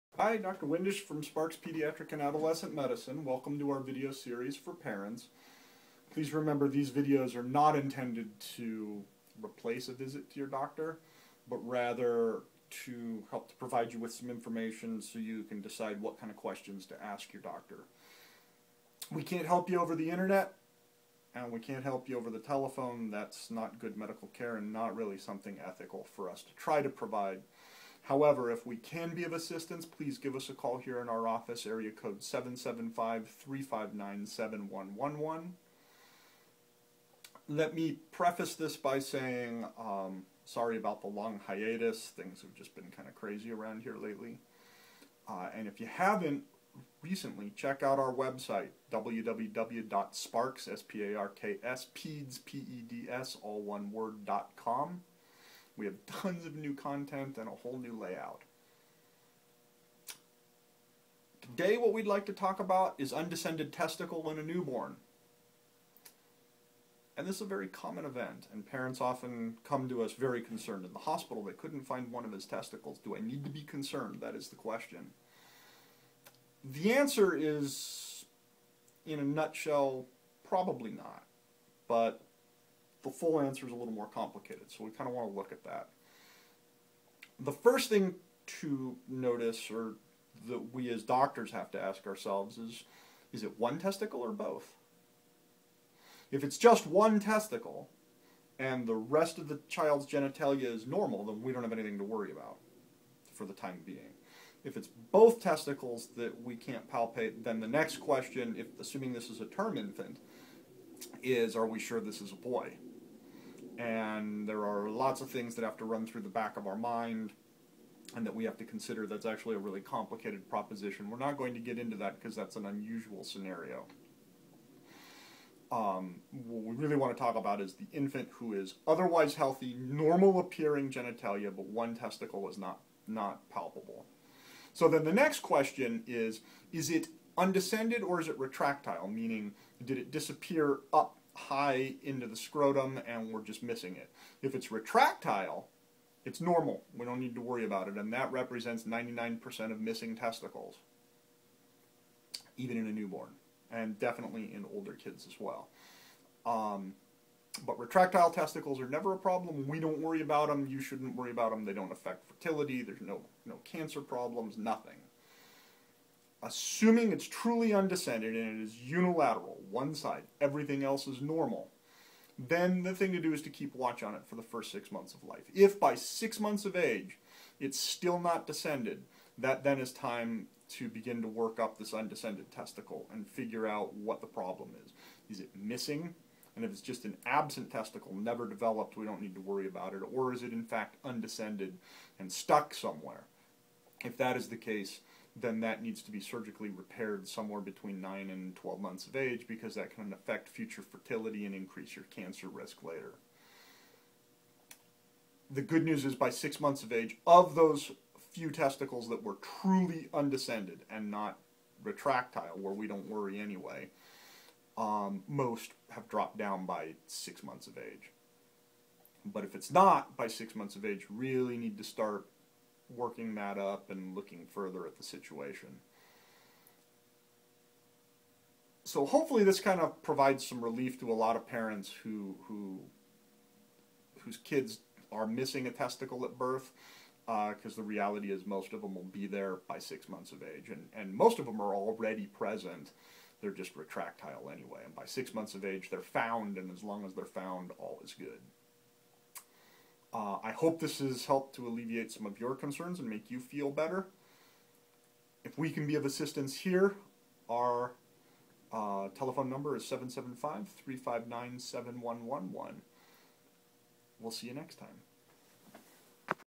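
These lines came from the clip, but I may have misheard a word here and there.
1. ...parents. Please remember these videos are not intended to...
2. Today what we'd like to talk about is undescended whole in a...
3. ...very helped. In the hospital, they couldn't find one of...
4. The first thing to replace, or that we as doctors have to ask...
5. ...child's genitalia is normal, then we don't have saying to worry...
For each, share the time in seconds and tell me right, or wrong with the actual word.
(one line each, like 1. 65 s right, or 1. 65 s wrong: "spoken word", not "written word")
1. 4 s right
2. 61 s wrong: "testicle", not "whole"
3. 70 s wrong: "concerned", not "helped"
4. 87 s wrong: "notice", not "replace"
5. 99 s wrong: "anything", not "saying".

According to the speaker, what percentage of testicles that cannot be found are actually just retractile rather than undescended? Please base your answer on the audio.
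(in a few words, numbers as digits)
99%.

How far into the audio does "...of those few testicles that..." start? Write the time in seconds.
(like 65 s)
207 s.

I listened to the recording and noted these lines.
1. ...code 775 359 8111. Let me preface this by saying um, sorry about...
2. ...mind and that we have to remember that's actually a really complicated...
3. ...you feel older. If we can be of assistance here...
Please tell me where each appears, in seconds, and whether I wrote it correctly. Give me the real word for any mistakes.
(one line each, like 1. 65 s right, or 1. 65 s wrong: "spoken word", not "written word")
1. 31 s wrong: "7111", not "8111"
2. 116 s wrong: "consider", not "remember"
3. 253 s wrong: "better", not "older".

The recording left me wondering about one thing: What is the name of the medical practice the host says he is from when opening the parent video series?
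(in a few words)
Sparks Pediatric and Adolescent Medicine.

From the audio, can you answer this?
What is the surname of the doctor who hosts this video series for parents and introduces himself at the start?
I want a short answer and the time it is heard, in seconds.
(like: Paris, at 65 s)
Windisch, at 0 s.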